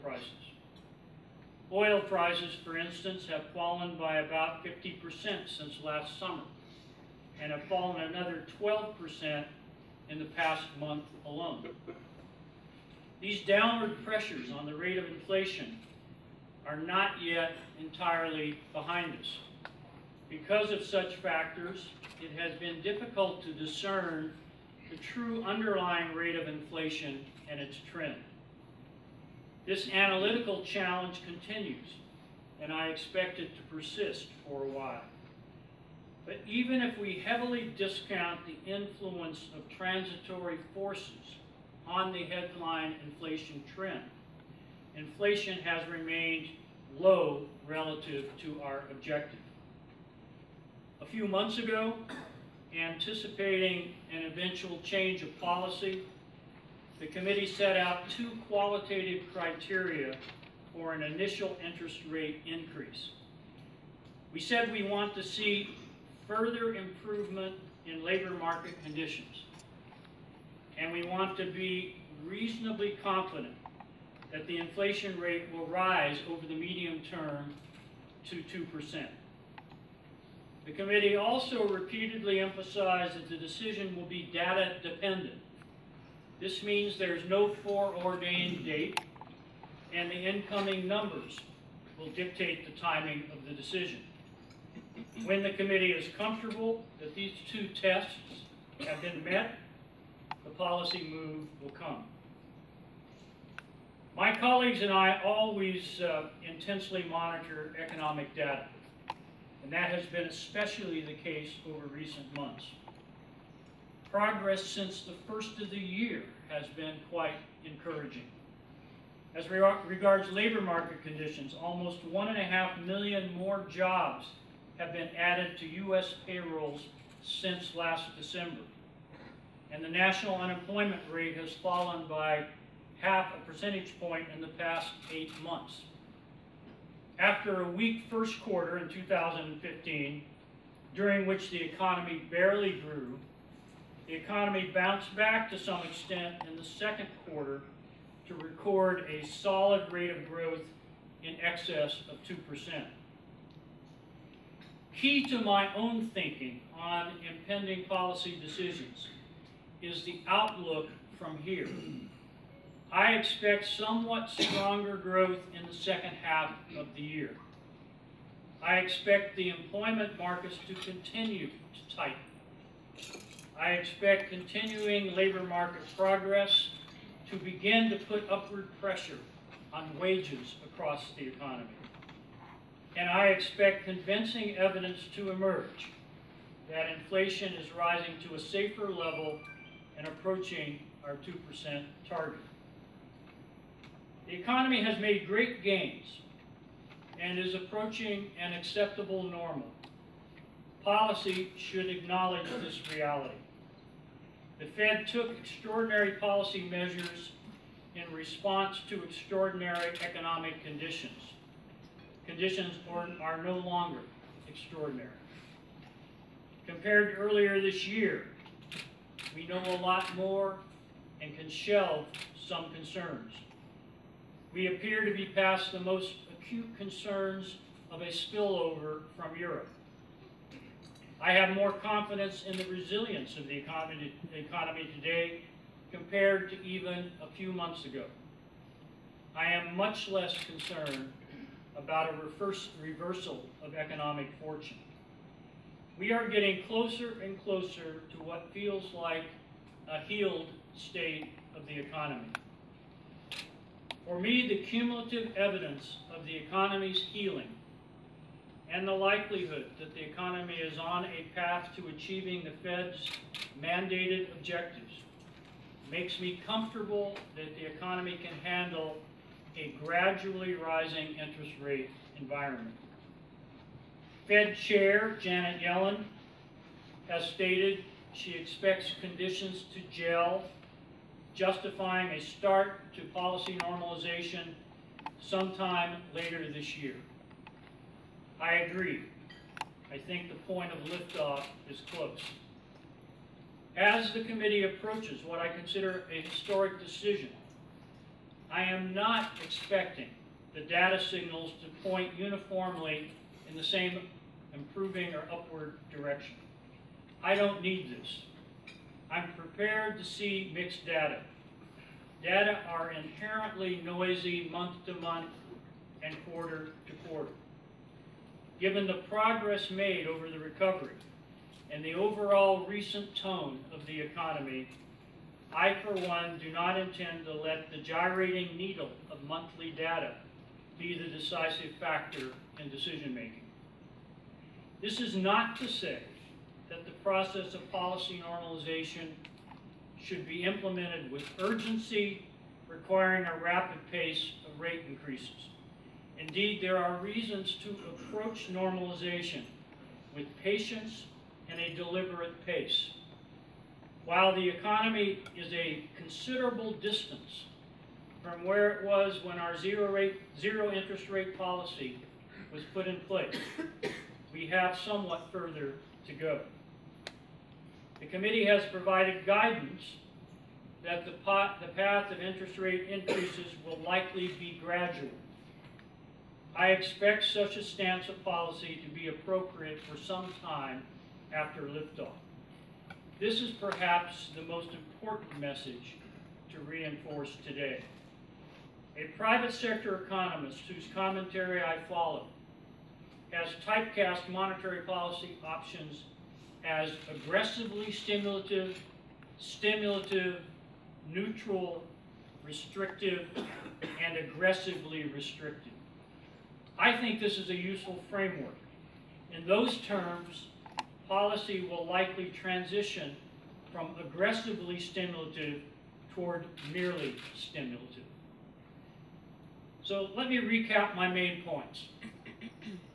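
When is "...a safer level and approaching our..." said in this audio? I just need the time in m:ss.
3:08.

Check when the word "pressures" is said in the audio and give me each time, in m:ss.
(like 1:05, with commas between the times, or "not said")
0:14, 2:58.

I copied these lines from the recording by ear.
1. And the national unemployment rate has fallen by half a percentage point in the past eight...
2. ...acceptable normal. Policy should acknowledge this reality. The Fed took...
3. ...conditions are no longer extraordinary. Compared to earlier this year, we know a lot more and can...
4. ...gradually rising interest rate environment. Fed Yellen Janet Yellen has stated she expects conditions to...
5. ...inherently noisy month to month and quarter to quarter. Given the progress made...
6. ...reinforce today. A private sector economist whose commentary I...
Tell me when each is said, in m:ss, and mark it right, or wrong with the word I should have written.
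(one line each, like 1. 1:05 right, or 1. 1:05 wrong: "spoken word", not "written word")
1. 2:09 right
2. 3:18 right
3. 3:32 right
4. 4:29 wrong: "Chair", not "Yellen"
5. 5:12 right
6. 6:26 right.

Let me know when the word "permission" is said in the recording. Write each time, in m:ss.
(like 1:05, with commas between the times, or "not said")
not said.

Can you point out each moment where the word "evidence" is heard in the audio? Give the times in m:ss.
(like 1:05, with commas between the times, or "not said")
3:04, 4:15.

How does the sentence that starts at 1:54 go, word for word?
Progress since the first of the year has been quite encouraging.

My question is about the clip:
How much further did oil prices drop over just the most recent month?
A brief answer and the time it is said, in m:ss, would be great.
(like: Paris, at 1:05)
12%, at 0:08.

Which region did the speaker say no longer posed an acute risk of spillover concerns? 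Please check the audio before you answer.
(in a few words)
Europe.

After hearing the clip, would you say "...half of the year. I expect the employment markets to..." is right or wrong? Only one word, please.
right.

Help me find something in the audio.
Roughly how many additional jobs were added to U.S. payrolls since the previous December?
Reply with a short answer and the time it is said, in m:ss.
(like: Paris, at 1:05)
1.5 million, at 2:02.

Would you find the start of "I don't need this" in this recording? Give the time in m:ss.
5:07.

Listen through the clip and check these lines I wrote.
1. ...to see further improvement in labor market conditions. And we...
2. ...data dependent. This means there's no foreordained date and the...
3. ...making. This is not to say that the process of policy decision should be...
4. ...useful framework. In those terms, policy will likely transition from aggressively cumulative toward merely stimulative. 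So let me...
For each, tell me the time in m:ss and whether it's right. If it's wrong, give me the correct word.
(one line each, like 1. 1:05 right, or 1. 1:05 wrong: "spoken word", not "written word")
1. 1:05 right
2. 1:24 right
3. 5:33 wrong: "normalization", not "decision"
4. 6:47 wrong: "stimulative", not "cumulative".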